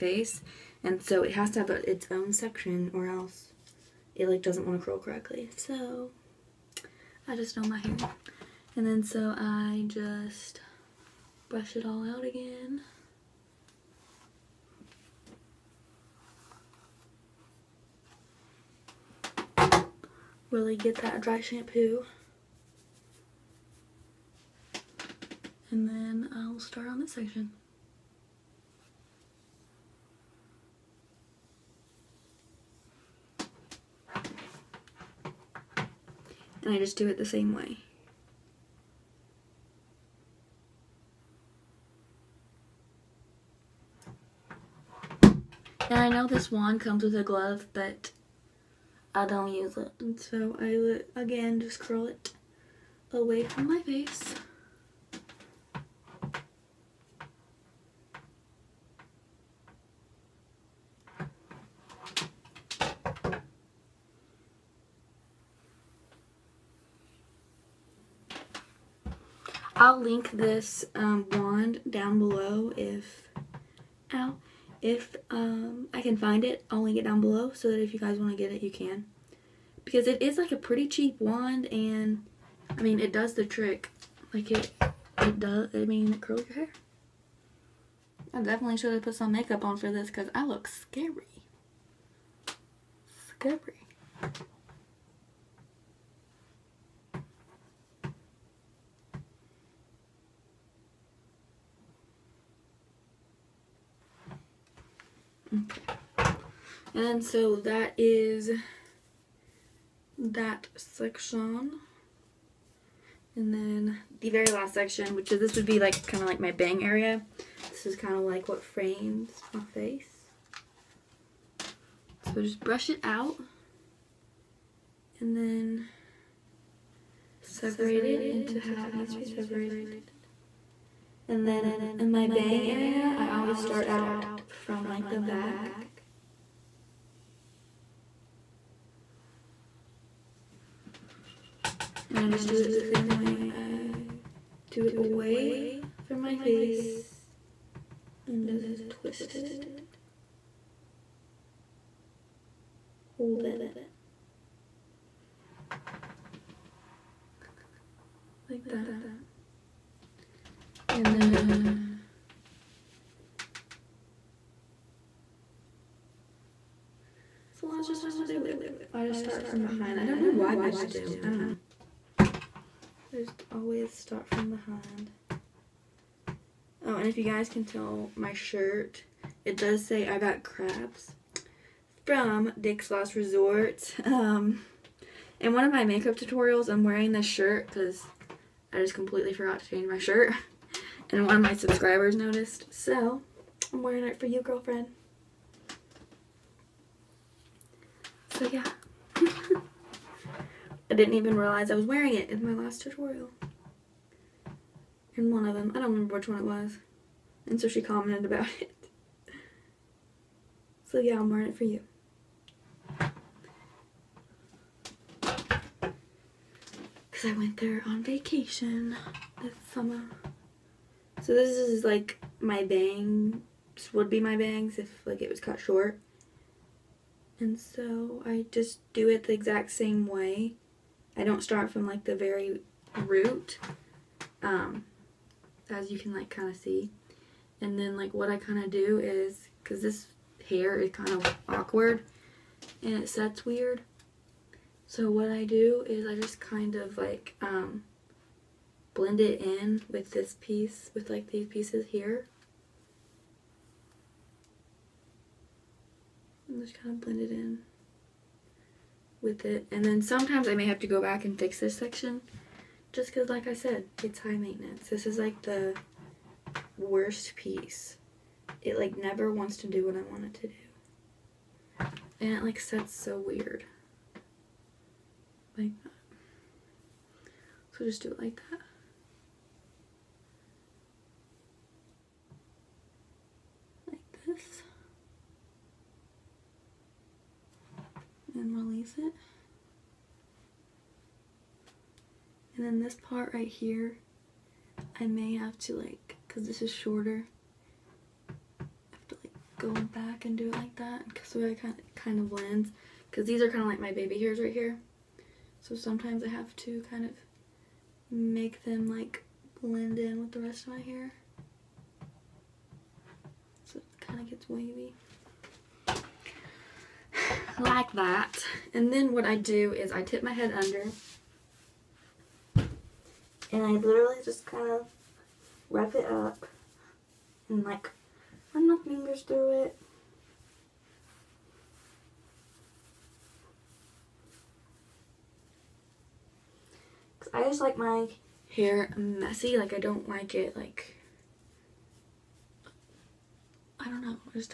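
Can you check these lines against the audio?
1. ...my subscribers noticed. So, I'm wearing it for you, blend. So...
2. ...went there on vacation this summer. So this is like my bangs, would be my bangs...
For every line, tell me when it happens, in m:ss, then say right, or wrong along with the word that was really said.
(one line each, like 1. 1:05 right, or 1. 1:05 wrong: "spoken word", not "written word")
1. 3:11 wrong: "girlfriend", not "blend"
2. 3:37 right.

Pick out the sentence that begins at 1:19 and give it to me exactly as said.
Because it is like a pretty cheap wand and I mean, it does the trick.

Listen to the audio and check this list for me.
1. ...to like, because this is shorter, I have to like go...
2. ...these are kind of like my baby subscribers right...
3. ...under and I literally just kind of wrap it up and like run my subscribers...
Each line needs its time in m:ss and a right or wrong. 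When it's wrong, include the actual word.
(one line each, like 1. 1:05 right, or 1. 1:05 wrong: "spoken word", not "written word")
1. 4:55 right
2. 5:03 wrong: "hairs", not "subscribers"
3. 5:20 wrong: "fingers", not "subscribers".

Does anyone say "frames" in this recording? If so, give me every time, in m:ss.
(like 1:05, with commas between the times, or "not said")
1:58.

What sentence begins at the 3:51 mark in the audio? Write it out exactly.
I don't start from like the very root, um, as you can like kind of see.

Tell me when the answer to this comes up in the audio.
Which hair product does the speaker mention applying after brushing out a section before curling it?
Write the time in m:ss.
0:21.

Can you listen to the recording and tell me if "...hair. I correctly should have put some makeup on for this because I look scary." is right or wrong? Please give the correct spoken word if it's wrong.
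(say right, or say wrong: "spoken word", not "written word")
wrong: "definitely", not "correctly".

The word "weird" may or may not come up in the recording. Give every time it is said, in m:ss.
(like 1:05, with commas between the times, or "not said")
4:03, 4:33.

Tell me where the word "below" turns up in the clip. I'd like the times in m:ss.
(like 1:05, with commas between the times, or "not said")
1:12, 1:17.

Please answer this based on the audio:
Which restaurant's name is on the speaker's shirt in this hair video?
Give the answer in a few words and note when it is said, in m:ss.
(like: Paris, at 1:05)
Dick's Last Resort, at 3:02.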